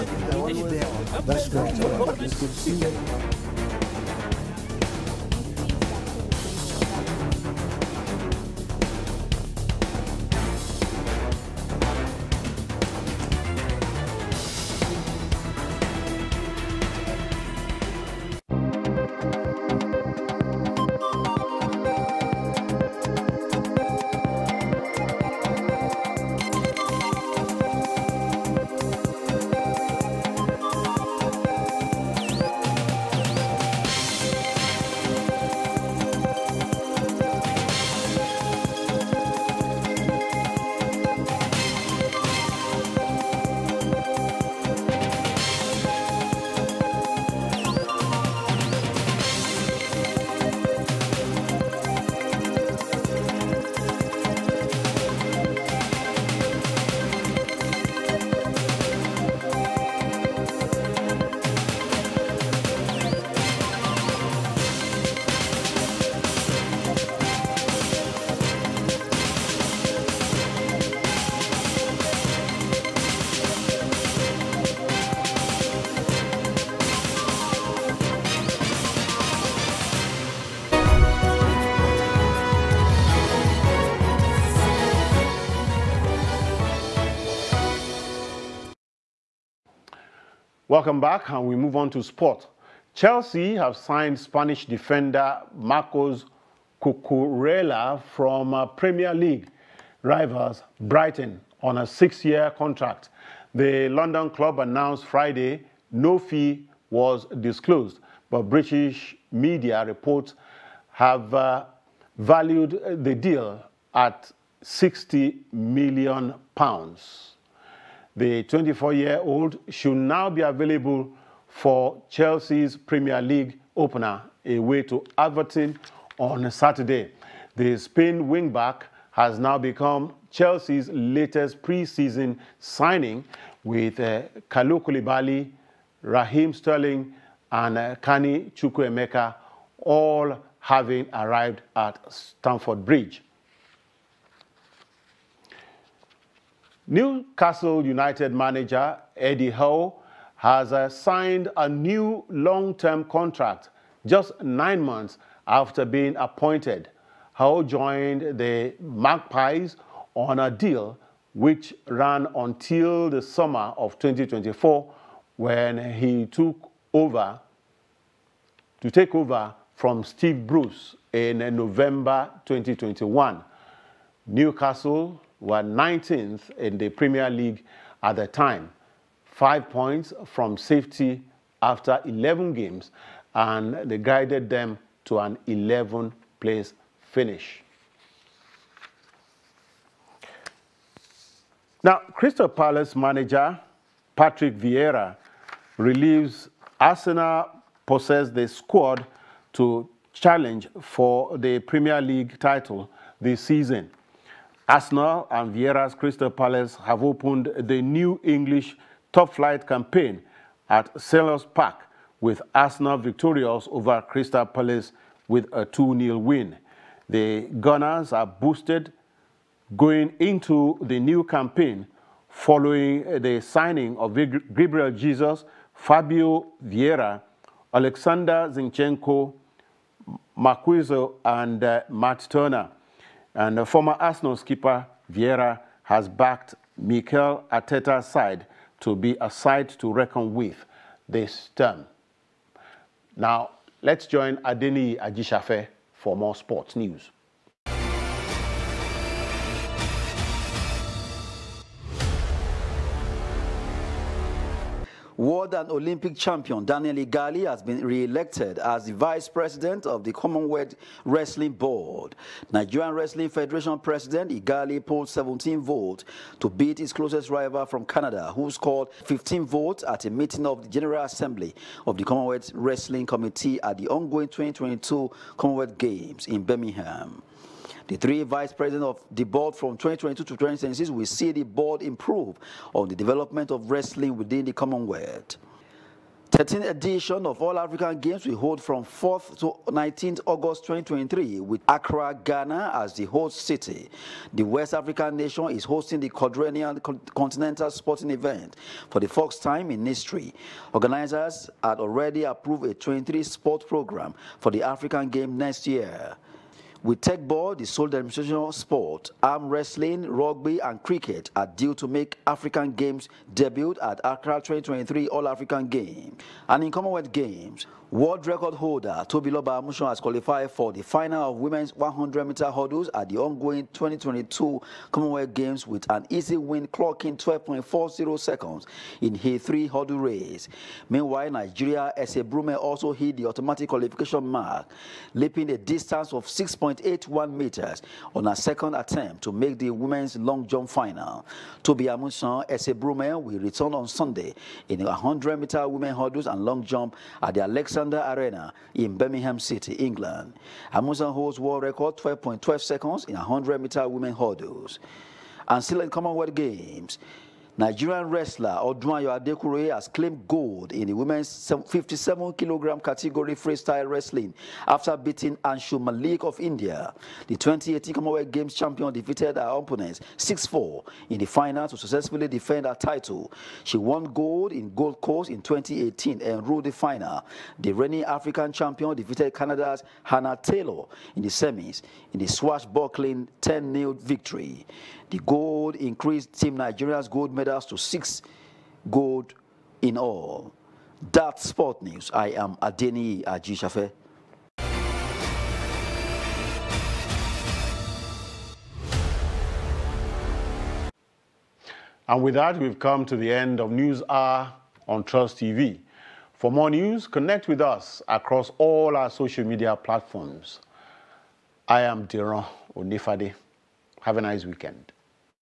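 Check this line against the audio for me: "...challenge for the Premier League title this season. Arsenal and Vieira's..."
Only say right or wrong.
right.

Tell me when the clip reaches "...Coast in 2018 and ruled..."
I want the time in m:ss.
6:15.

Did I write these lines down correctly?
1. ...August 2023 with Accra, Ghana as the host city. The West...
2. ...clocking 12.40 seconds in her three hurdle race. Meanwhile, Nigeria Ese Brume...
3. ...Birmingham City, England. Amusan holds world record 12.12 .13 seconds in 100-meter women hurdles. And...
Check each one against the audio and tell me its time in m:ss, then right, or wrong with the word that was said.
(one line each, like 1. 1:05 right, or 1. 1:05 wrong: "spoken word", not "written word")
1. 4:50 right
2. 5:26 right
3. 5:48 wrong: "12", not "13".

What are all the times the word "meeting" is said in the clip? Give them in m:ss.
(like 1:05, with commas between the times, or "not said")
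4:30.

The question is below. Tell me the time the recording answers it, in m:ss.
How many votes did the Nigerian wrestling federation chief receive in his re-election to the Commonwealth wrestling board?
4:25.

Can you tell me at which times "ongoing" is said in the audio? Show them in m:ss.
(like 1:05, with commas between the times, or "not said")
4:33, 5:23.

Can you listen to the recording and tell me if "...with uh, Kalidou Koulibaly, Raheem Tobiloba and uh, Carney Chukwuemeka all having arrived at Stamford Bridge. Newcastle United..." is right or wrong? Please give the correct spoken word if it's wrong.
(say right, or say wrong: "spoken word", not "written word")
wrong: "Sterling", not "Tobiloba".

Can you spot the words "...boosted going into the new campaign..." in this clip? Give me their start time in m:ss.
3:38.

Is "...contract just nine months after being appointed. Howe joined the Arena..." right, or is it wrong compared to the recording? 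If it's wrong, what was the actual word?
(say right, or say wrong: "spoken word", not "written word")
wrong: "Magpies", not "Arena".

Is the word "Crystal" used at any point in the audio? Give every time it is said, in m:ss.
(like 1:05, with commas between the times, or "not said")
3:12, 3:25, 3:34.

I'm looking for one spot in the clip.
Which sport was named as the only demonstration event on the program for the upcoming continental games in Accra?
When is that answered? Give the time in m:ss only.
5:06.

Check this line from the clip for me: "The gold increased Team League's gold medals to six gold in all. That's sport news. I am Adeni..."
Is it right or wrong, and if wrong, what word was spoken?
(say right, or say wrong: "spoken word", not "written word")
wrong: "Nigeria", not "League".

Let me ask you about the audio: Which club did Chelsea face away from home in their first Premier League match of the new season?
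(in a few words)
Everton.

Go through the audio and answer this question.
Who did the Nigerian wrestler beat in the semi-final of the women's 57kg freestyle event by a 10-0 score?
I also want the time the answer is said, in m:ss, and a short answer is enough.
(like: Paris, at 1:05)
Hannah Taylor, at 6:20.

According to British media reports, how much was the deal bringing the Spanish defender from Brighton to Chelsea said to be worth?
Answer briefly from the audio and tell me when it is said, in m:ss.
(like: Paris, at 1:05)
60 million pounds, at 1:54.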